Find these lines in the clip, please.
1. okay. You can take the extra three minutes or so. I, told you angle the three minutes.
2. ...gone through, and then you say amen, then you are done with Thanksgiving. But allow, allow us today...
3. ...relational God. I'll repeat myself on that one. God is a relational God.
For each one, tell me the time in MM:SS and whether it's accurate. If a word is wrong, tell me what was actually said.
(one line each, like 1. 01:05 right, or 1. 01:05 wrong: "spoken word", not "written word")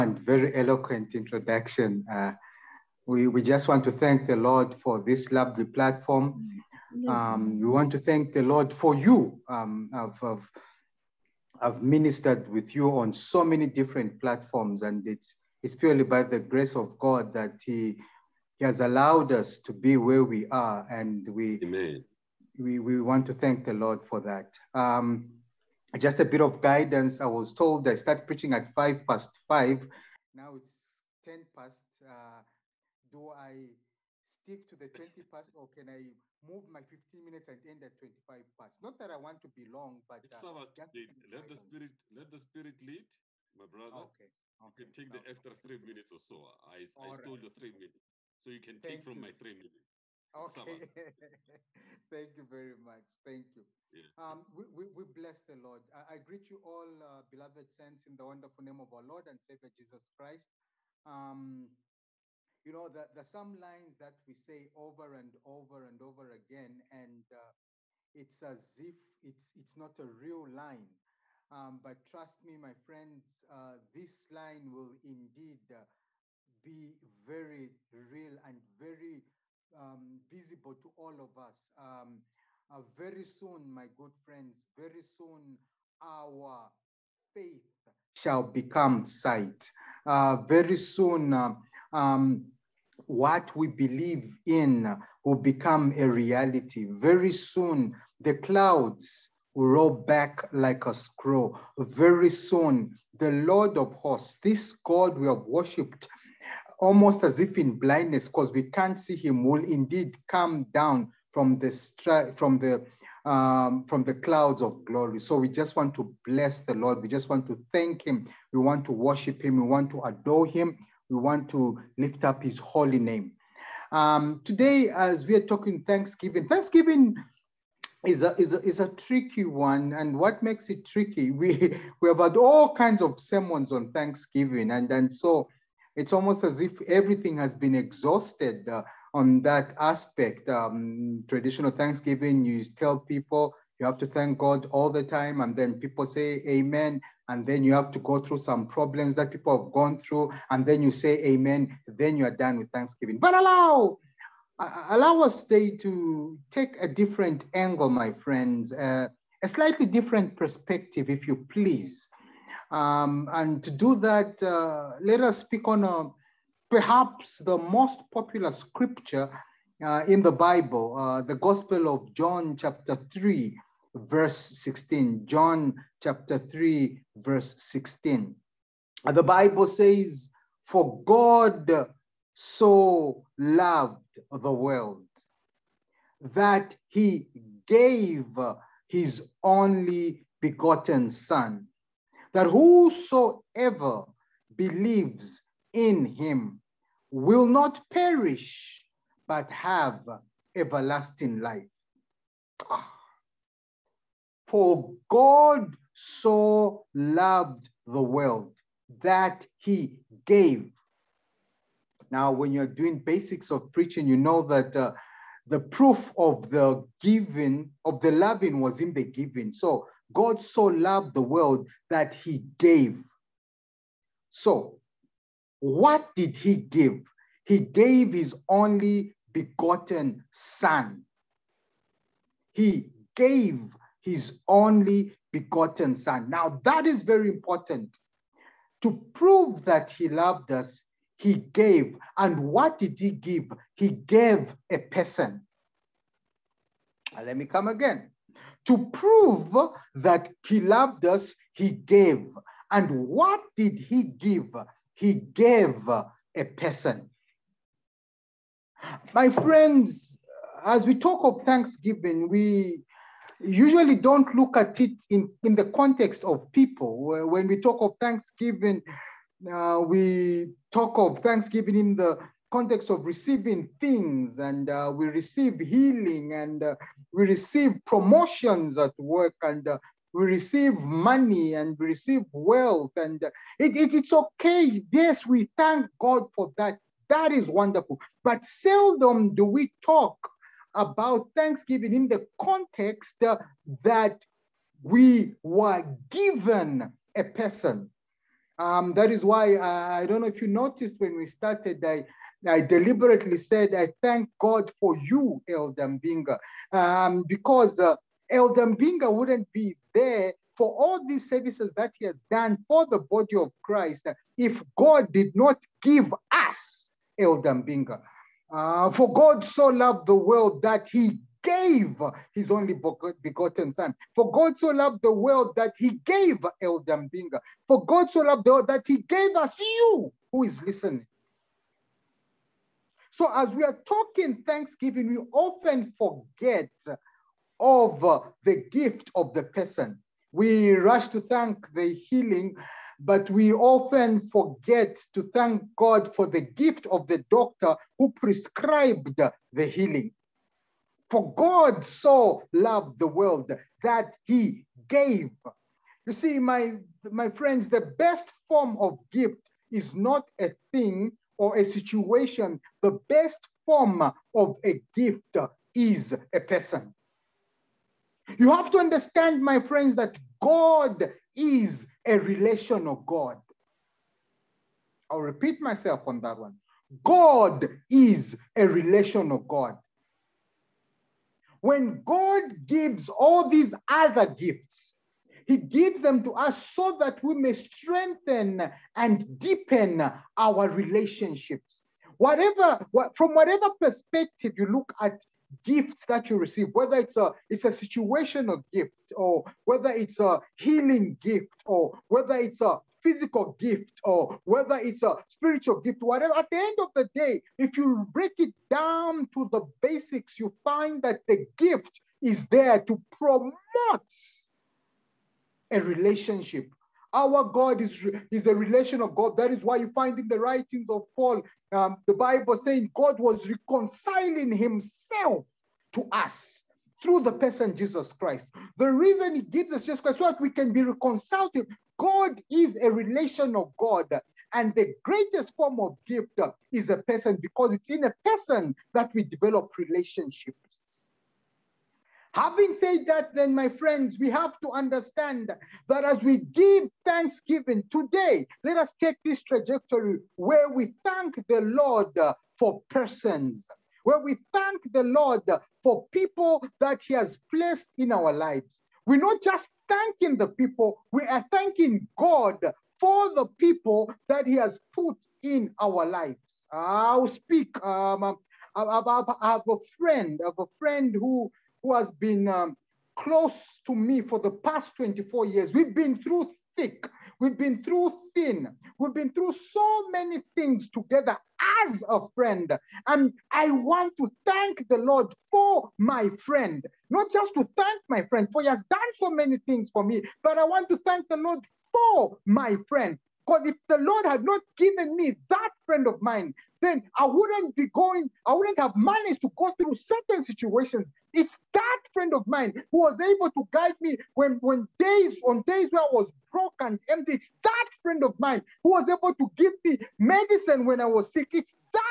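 1. 00:44 wrong: "stole", not "angle"
2. 02:29 right
3. 06:12 right.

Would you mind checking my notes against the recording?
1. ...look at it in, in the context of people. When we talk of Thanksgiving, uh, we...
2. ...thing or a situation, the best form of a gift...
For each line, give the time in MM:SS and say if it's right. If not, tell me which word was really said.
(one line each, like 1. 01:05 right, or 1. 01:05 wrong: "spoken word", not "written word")
1. 04:24 right
2. 06:00 right.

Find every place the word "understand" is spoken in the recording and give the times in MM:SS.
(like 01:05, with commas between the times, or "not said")
06:08, 07:24.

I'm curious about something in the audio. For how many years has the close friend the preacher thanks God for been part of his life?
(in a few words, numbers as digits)
24.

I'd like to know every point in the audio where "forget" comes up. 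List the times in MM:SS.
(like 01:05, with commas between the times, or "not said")
05:35, 05:44.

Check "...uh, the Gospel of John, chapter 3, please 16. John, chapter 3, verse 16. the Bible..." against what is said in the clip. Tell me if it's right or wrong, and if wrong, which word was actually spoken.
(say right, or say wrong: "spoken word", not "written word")
wrong: "verse", not "please".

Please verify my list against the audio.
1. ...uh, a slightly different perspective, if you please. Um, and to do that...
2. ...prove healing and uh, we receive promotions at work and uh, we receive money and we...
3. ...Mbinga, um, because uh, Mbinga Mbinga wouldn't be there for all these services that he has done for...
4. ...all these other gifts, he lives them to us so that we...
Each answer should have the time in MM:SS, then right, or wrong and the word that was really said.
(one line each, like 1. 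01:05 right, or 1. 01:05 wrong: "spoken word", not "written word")
1. 02:38 right
2. 04:35 wrong: "receive", not "prove"
3. 05:05 wrong: "Elder", not "Mbinga"
4. 06:23 wrong: "gives", not "lives".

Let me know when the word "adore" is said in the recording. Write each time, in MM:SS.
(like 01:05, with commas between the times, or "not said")
02:00.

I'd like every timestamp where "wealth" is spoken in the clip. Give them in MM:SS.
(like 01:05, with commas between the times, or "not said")
04:42.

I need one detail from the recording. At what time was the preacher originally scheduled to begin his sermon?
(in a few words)
5:05.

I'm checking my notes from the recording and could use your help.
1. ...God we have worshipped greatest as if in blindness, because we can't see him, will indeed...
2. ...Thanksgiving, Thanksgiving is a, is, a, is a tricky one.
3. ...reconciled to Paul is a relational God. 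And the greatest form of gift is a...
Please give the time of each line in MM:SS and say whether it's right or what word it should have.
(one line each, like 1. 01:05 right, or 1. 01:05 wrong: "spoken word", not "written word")
1. 01:44 wrong: "almost", not "greatest"
2. 02:05 right
3. 07:10 wrong: "God", not "Paul".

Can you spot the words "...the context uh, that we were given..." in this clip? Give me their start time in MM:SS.
04:52.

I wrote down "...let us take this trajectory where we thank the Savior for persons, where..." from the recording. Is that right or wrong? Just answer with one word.
wrong.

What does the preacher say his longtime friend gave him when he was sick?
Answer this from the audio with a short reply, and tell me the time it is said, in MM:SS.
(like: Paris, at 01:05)
medicine, at 08:30.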